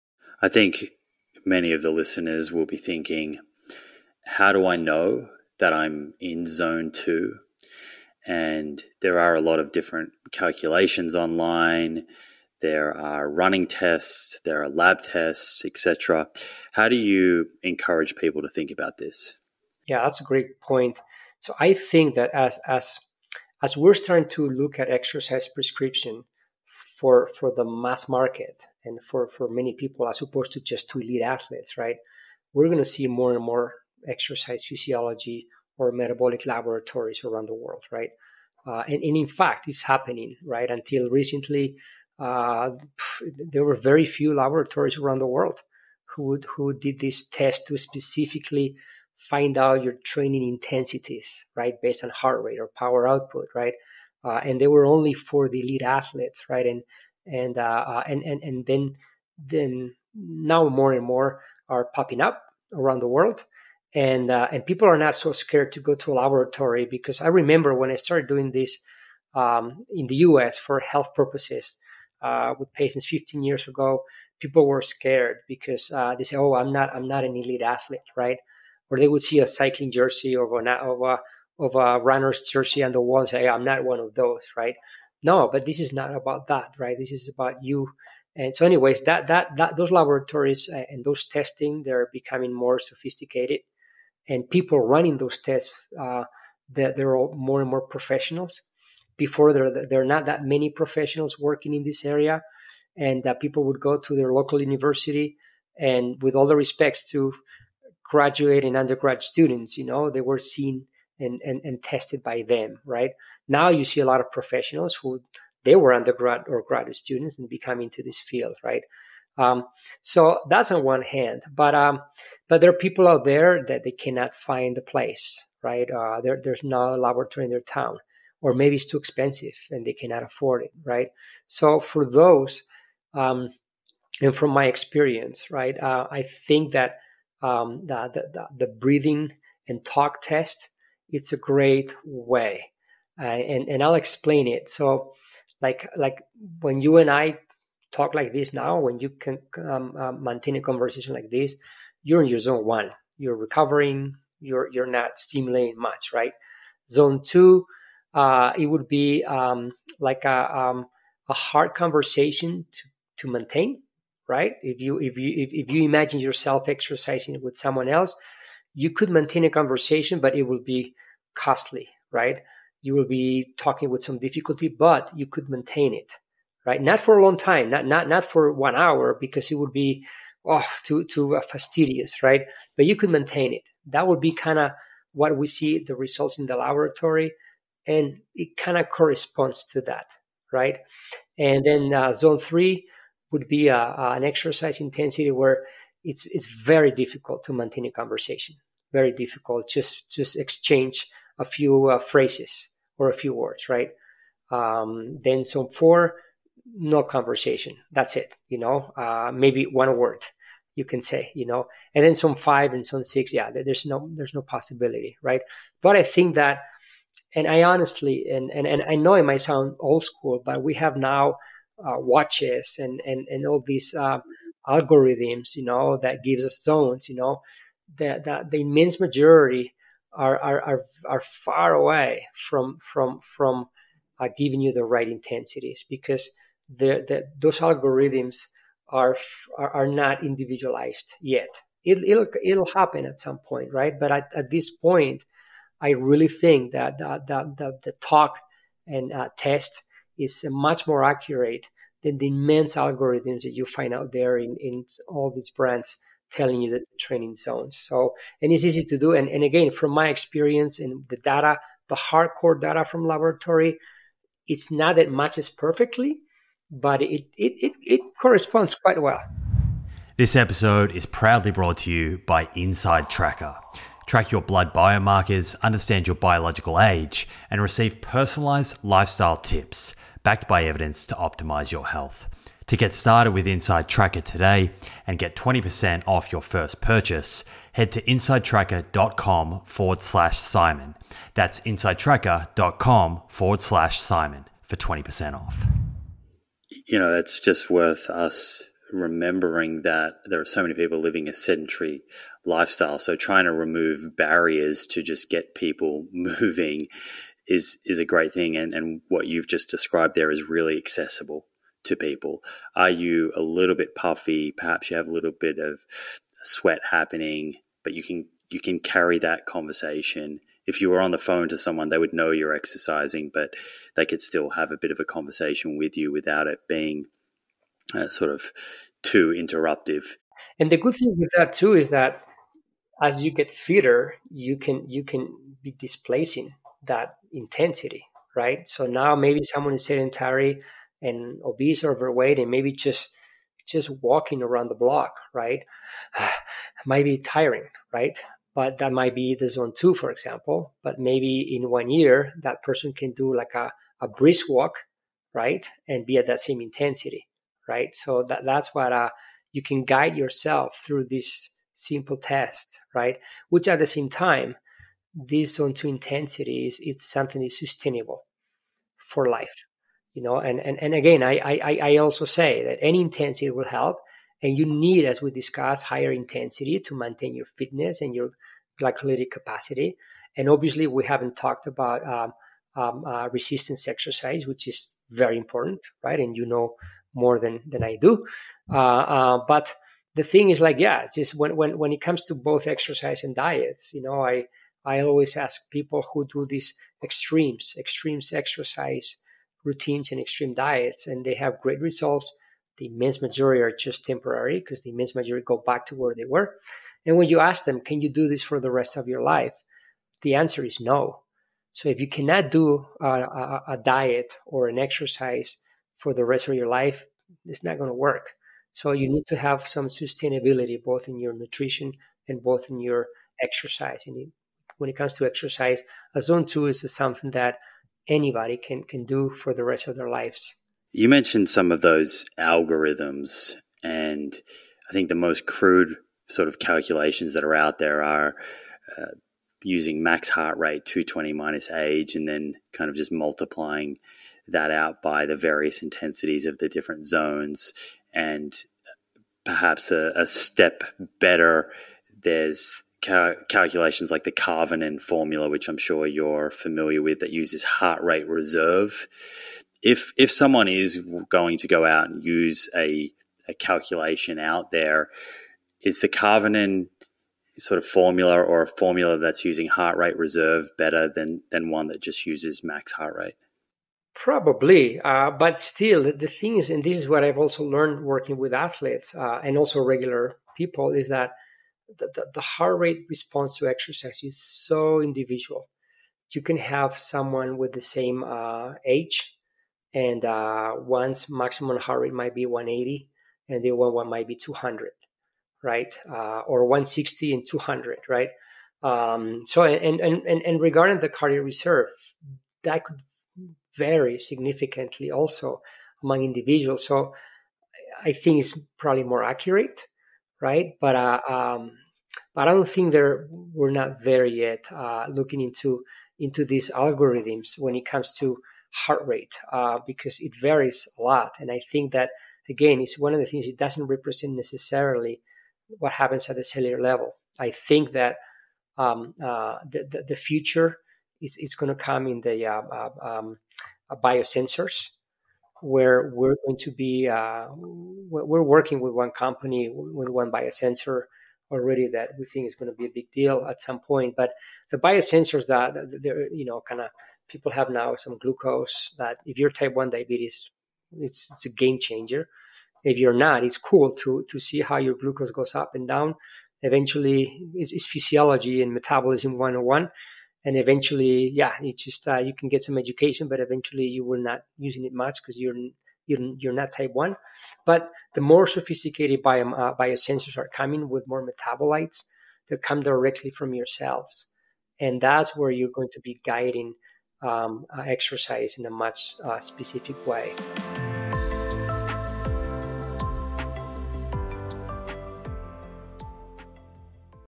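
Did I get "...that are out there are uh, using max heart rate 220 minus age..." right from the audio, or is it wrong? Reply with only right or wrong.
right.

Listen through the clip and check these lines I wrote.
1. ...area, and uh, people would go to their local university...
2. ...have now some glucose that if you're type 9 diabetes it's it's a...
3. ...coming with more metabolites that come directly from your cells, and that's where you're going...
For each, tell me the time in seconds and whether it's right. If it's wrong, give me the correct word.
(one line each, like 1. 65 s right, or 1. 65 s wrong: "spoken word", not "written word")
1. 102 s right
2. 547 s wrong: "1", not "9"
3. 570 s right.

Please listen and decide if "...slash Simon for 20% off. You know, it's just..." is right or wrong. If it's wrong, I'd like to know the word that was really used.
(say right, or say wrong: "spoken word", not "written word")
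right.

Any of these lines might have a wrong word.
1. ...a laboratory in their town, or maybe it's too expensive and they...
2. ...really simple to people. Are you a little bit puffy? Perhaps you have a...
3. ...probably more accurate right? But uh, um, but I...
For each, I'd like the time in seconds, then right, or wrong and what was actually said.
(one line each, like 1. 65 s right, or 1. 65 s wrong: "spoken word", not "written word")
1. 126 s right
2. 310 s wrong: "accessible", not "simple"
3. 508 s right.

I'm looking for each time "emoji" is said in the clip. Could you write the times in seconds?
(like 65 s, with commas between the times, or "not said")
not said.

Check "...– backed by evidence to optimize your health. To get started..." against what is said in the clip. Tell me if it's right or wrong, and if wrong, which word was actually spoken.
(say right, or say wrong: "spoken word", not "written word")
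right.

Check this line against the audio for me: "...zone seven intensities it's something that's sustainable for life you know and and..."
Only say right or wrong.
wrong.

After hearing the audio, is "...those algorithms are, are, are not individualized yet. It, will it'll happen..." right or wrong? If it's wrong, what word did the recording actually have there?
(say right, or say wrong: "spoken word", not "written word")
right.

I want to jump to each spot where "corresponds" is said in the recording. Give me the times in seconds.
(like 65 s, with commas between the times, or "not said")
188 s, 268 s.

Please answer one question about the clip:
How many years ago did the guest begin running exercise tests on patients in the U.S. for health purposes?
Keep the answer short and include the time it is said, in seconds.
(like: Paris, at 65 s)
15, at 73 s.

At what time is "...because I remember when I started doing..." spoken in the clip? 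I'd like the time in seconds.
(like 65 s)
66 s.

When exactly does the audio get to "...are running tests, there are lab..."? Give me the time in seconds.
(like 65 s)
12 s.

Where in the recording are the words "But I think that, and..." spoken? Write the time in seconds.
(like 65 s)
215 s.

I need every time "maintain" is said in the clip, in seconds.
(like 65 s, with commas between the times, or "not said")
150 s, 163 s, 169 s, 175 s, 183 s, 197 s, 376 s.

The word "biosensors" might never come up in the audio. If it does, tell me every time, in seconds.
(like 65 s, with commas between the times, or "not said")
534 s, 540 s, 544 s, 569 s.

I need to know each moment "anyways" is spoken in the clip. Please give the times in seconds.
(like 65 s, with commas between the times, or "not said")
88 s.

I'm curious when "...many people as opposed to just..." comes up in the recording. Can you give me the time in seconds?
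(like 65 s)
29 s.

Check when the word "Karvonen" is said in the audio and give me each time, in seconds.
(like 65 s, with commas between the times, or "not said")
454 s, 466 s.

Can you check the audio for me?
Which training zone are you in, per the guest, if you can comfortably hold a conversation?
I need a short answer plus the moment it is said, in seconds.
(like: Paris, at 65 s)
zone one, at 152 s.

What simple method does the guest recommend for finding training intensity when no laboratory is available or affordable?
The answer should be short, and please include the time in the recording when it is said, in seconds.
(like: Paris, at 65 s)
breathing and talk test, at 138 s.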